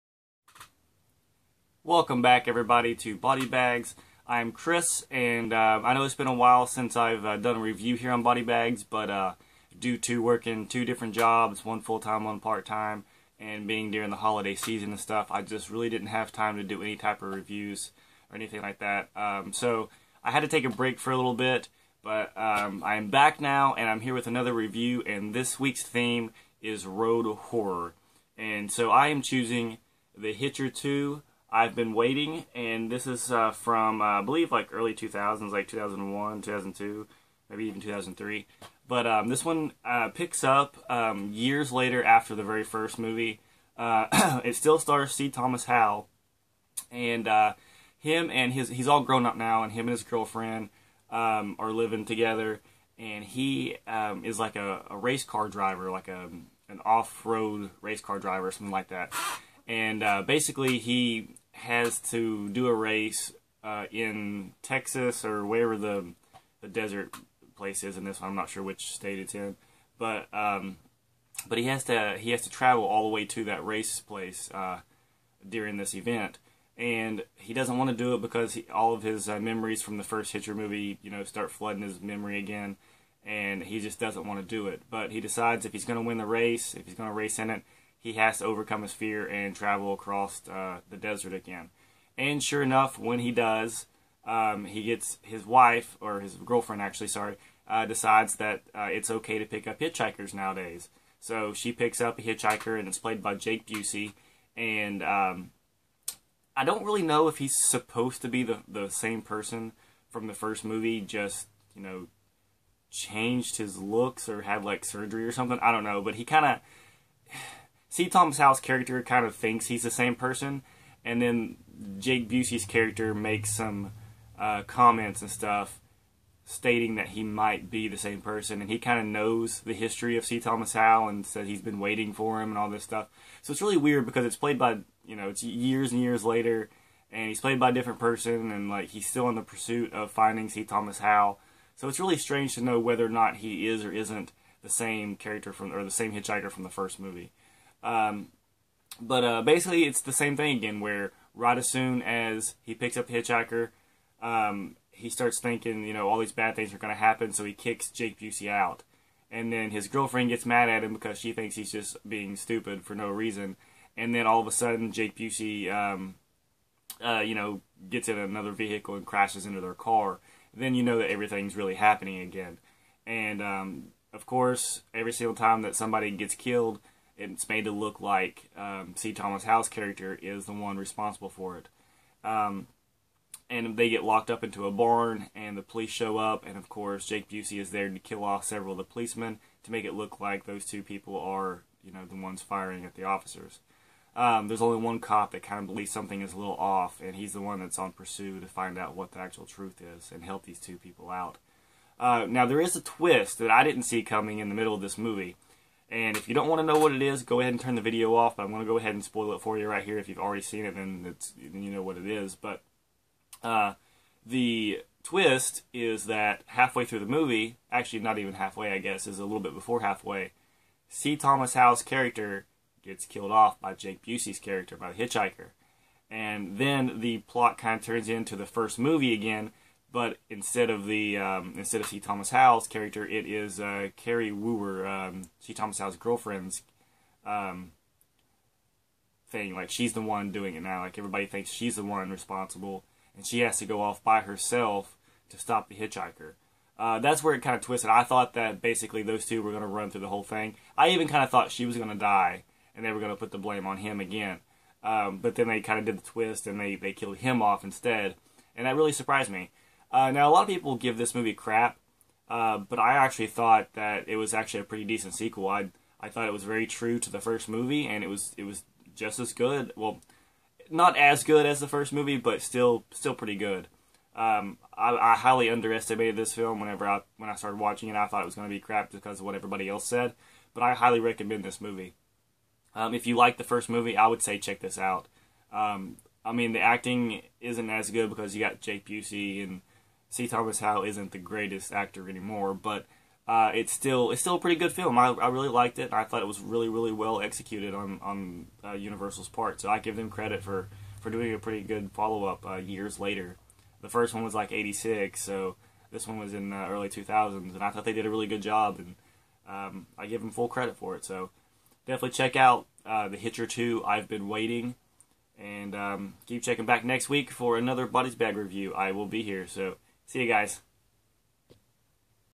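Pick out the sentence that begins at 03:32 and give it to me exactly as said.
But uh, the twist is that halfway through the movie, actually not even halfway, I guess, is a little bit before halfway.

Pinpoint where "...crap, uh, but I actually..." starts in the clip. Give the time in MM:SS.
04:21.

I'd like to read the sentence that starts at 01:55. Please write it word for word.
I don't know, but he kind of.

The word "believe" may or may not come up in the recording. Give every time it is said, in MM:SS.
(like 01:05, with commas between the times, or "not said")
00:34, 03:15.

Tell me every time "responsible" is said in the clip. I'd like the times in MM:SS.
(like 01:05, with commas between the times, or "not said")
03:00, 04:02.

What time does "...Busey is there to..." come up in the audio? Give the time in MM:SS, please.
03:07.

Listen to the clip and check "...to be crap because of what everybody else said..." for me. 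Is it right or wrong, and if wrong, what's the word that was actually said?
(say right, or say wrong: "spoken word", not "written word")
right.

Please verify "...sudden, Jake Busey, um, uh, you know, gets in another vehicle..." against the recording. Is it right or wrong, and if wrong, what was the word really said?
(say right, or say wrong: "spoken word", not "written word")
right.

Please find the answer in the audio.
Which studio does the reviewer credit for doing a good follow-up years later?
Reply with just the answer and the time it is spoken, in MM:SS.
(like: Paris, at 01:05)
Universal, at 04:58.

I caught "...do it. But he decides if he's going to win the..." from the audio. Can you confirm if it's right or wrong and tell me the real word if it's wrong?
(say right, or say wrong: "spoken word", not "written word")
right.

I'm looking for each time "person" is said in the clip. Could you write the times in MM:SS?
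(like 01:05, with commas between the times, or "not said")
01:49, 02:00, 02:08, 02:17.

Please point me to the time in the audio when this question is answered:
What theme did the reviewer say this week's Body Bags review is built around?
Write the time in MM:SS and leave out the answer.
00:26.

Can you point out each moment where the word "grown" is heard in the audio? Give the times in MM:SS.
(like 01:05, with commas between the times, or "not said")
00:49.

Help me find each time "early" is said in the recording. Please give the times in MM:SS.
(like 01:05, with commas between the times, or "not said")
00:34, 05:06.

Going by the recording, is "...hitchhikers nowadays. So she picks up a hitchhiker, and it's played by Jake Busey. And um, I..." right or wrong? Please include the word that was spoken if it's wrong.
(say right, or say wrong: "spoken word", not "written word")
right.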